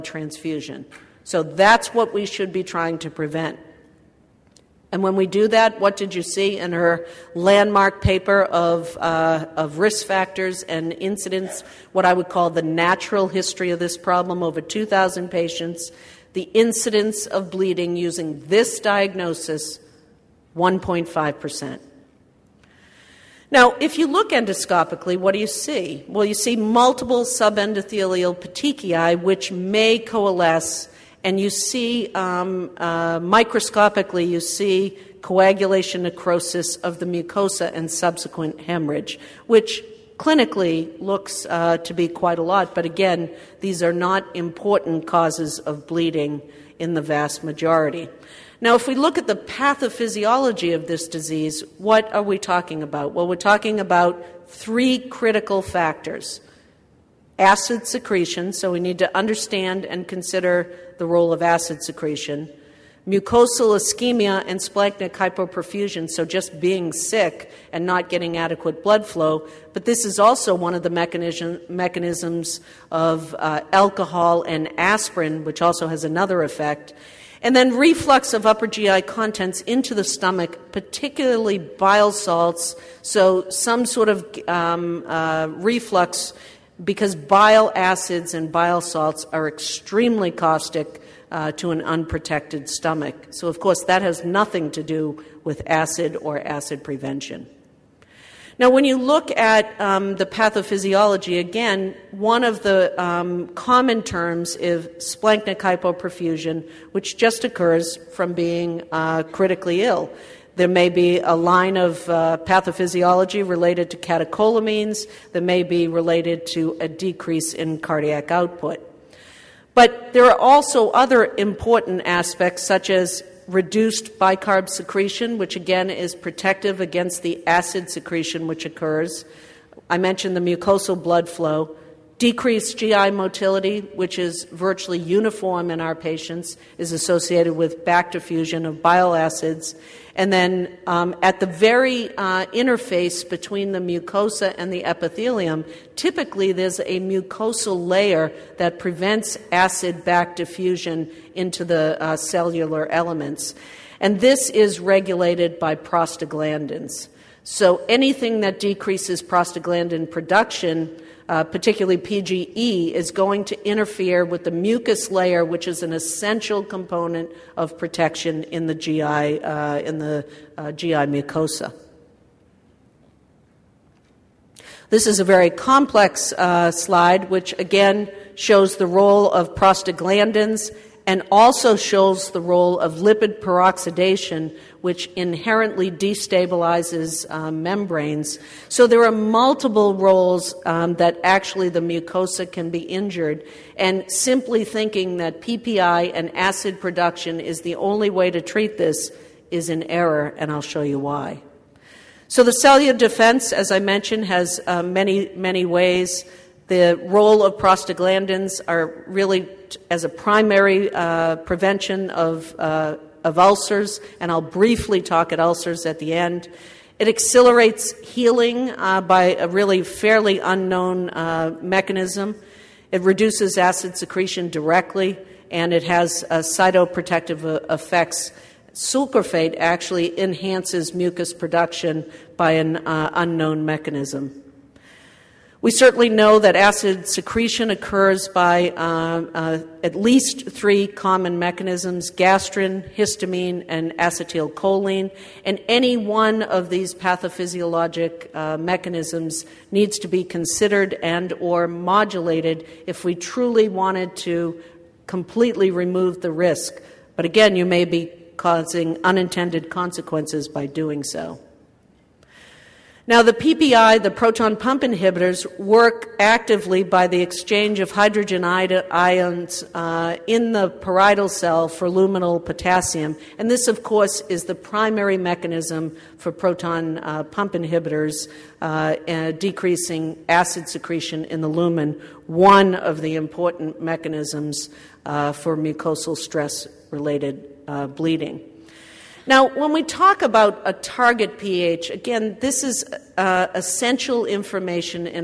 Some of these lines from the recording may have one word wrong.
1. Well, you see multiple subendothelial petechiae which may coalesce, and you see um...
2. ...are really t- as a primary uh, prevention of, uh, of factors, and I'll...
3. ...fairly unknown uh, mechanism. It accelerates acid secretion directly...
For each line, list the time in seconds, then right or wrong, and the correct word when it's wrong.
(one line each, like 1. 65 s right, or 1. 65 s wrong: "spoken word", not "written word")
1. 26 s right
2. 208 s wrong: "ulcers", not "factors"
3. 219 s wrong: "reduces", not "accelerates".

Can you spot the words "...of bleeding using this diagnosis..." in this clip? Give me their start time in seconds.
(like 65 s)
17 s.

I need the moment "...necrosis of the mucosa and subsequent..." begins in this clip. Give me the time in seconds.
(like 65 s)
36 s.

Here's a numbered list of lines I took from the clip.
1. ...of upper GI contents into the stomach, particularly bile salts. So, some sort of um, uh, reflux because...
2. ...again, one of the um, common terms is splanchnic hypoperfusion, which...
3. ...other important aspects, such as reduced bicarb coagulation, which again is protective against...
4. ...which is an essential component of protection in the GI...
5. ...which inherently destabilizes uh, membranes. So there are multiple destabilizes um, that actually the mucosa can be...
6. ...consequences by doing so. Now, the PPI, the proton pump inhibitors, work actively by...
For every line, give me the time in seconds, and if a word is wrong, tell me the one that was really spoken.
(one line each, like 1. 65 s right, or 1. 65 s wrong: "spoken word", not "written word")
1. 78 s right
2. 101 s right
3. 120 s wrong: "secretion", not "coagulation"
4. 165 s right
5. 184 s wrong: "roles", not "destabilizes"
6. 259 s right.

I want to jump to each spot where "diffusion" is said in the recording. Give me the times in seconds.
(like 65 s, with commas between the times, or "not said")
138 s, 150 s.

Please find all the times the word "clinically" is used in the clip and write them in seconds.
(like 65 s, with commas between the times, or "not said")
40 s.